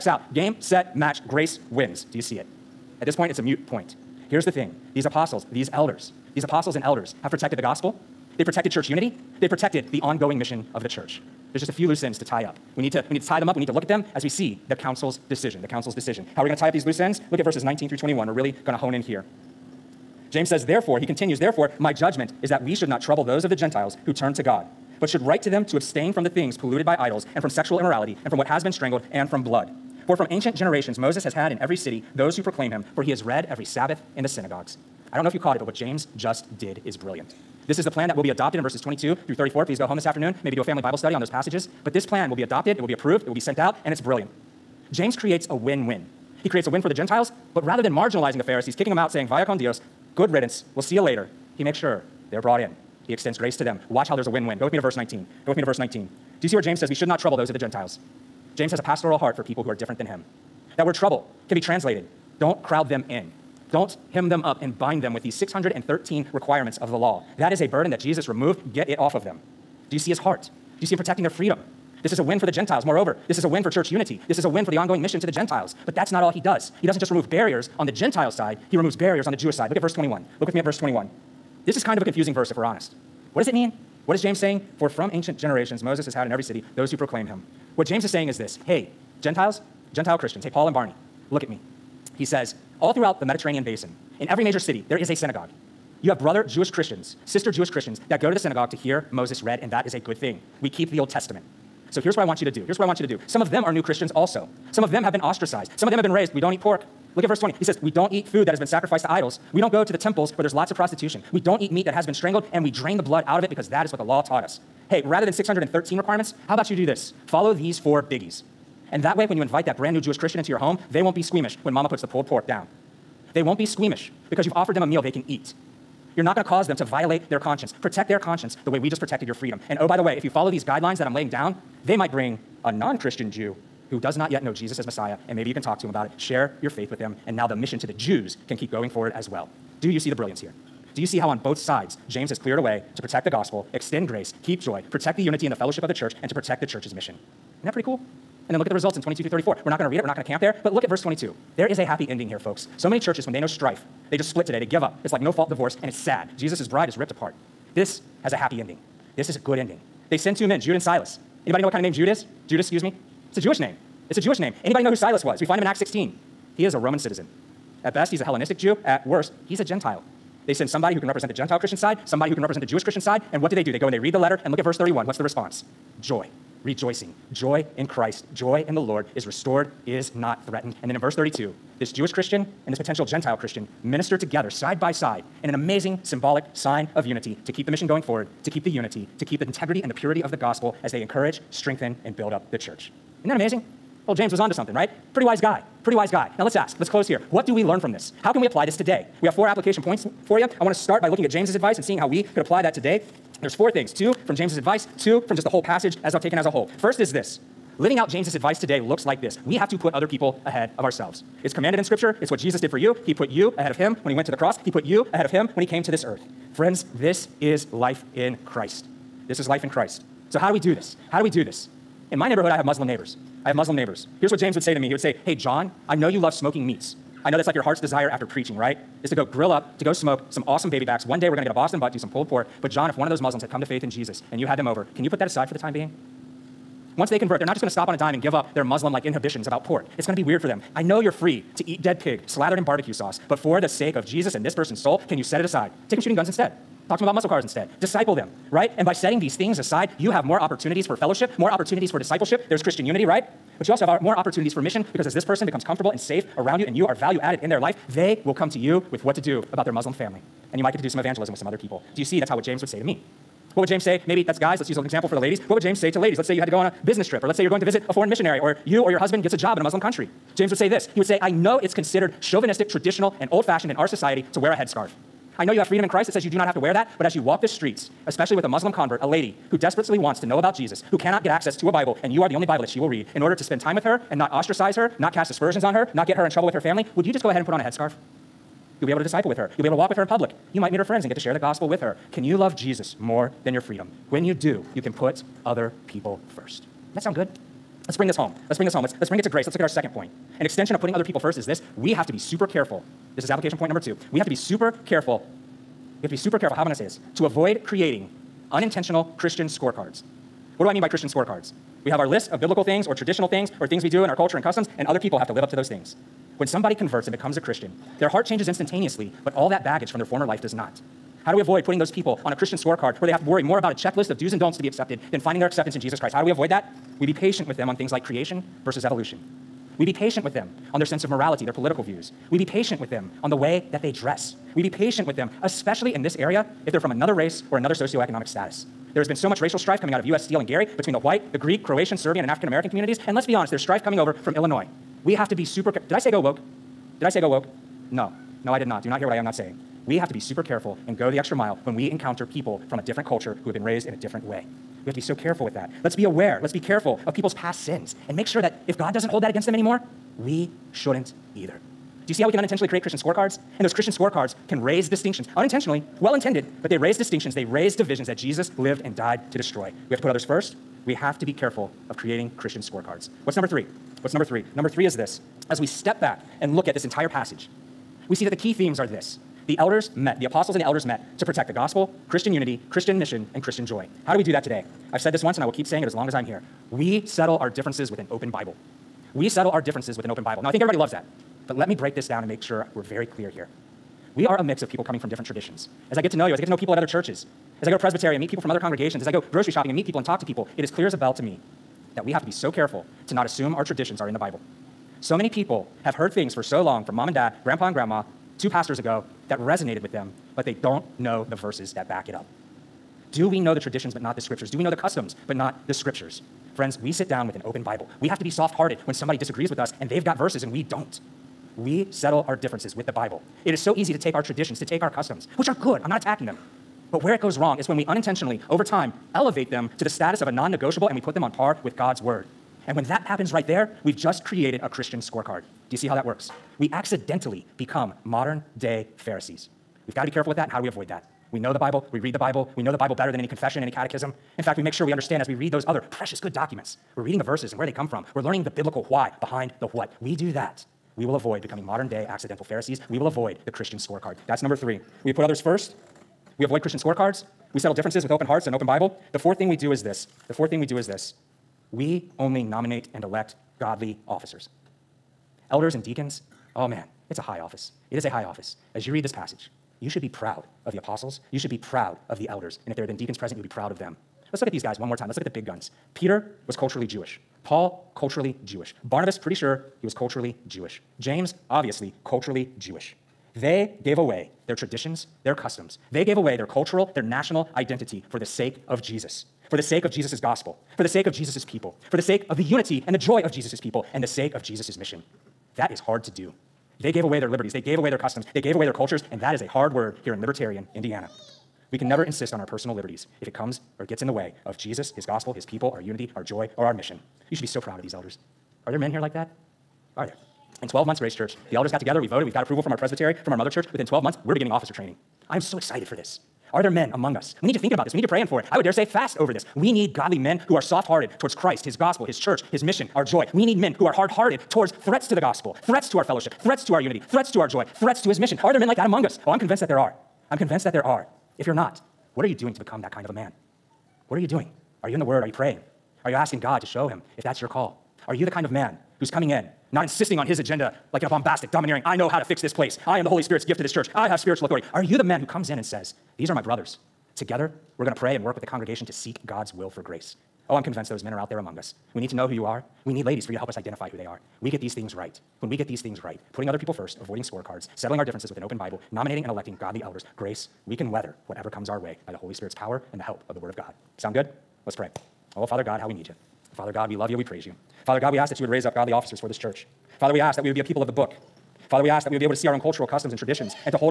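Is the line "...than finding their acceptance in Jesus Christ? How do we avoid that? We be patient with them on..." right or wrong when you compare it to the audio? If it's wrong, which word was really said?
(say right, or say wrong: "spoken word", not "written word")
right.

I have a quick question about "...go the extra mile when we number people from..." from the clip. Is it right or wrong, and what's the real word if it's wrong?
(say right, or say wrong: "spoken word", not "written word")
wrong: "encounter", not "number".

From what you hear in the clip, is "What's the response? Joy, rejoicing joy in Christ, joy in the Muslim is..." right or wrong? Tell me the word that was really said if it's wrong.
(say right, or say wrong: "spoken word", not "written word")
wrong: "Lord", not "Muslim".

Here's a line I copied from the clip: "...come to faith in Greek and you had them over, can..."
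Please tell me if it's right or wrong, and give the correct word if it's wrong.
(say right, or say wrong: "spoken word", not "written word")
wrong: "Jesus", not "Greek".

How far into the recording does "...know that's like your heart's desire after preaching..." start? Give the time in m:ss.
3:47.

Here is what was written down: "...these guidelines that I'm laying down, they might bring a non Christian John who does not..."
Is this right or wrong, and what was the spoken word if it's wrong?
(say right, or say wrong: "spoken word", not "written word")
wrong: "Jew", not "John".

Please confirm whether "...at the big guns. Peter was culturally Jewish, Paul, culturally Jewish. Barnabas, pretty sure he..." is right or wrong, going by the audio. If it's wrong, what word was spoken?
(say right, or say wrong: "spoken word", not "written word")
right.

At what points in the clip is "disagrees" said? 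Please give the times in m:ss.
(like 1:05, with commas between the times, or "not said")
6:59.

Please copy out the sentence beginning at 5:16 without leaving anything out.
When somebody converts and becomes a Christian, their heart changes instantaneously, but all that baggage from their former life does not.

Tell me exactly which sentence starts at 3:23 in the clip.
There's four things two from James's advice, two from just the whole passage as taken as a whole.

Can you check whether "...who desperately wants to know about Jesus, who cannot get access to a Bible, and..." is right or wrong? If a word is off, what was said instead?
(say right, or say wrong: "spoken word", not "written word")
right.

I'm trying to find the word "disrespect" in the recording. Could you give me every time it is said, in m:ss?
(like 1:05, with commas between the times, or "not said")
not said.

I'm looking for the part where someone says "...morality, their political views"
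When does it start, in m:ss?
5:31.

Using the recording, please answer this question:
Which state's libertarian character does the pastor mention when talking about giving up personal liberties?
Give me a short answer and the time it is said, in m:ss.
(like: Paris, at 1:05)
Indiana, at 8:20.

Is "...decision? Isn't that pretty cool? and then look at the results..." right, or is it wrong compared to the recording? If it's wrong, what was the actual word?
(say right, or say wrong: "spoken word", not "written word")
wrong: "mission", not "decision".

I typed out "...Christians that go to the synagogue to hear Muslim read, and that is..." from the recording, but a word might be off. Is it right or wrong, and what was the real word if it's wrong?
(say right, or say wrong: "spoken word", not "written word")
wrong: "Moses", not "Muslim".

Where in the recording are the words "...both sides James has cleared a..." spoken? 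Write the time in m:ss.
2:21.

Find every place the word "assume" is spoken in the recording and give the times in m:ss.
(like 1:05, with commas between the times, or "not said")
6:43.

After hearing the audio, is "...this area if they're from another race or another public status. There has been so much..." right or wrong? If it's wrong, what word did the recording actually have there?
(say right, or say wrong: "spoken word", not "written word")
wrong: "socioeconomic", not "public".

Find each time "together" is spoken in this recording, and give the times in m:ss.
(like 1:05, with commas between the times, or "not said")
3:04, 8:31, 9:07.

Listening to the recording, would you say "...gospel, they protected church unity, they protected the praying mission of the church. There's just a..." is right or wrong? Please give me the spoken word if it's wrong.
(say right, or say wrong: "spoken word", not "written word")
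wrong: "ongoing", not "praying".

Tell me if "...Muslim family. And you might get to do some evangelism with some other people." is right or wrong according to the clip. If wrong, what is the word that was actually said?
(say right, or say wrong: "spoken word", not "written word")
right.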